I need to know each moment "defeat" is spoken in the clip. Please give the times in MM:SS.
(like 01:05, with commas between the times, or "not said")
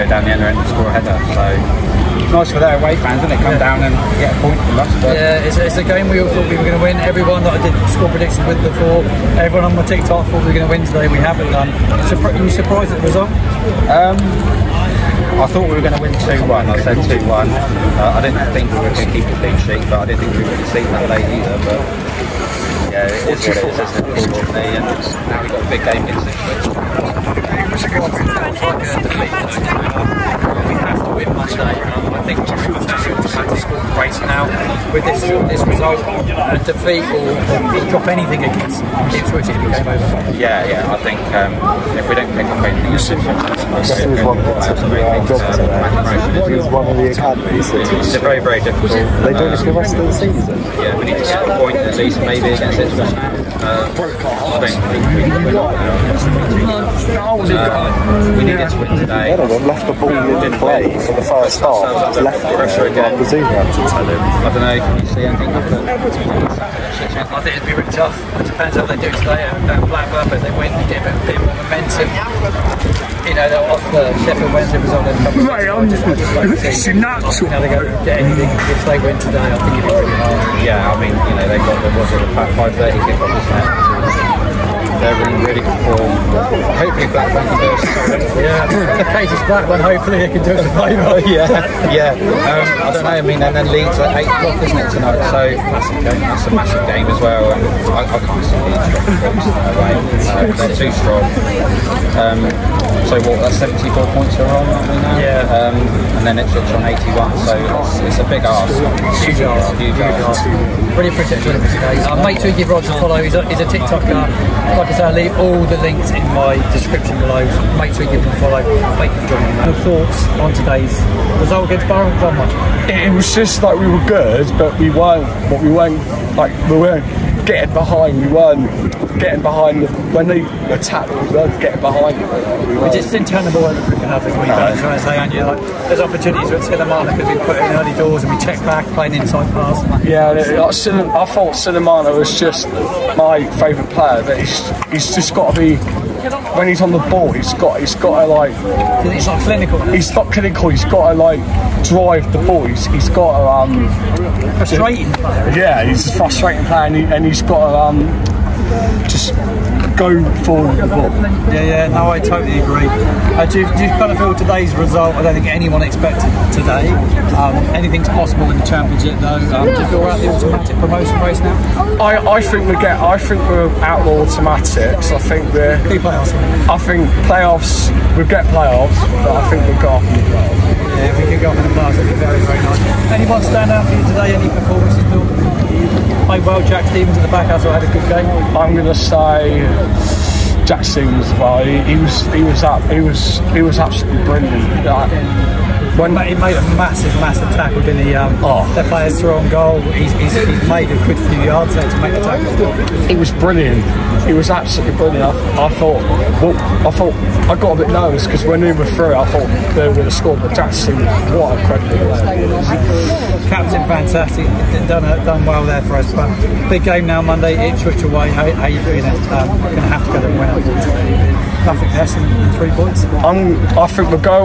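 00:36.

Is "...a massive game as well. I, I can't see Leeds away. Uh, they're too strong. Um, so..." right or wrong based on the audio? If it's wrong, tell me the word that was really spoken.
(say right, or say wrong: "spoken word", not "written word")
right.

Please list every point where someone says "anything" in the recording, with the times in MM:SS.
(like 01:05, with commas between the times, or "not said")
00:38, 00:42, 01:05, 01:18, 02:47.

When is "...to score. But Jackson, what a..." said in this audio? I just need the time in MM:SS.
03:30.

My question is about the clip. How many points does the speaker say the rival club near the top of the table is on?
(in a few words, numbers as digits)
81.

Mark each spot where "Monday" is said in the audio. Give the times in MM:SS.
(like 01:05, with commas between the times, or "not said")
00:31, 03:37.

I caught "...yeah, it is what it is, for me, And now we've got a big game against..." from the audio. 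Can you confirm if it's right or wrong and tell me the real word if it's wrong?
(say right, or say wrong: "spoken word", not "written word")
right.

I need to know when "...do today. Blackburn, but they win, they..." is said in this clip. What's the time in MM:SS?
01:08.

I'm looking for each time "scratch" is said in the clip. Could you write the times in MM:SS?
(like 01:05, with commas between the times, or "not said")
not said.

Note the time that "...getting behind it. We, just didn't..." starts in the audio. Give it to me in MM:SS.
02:11.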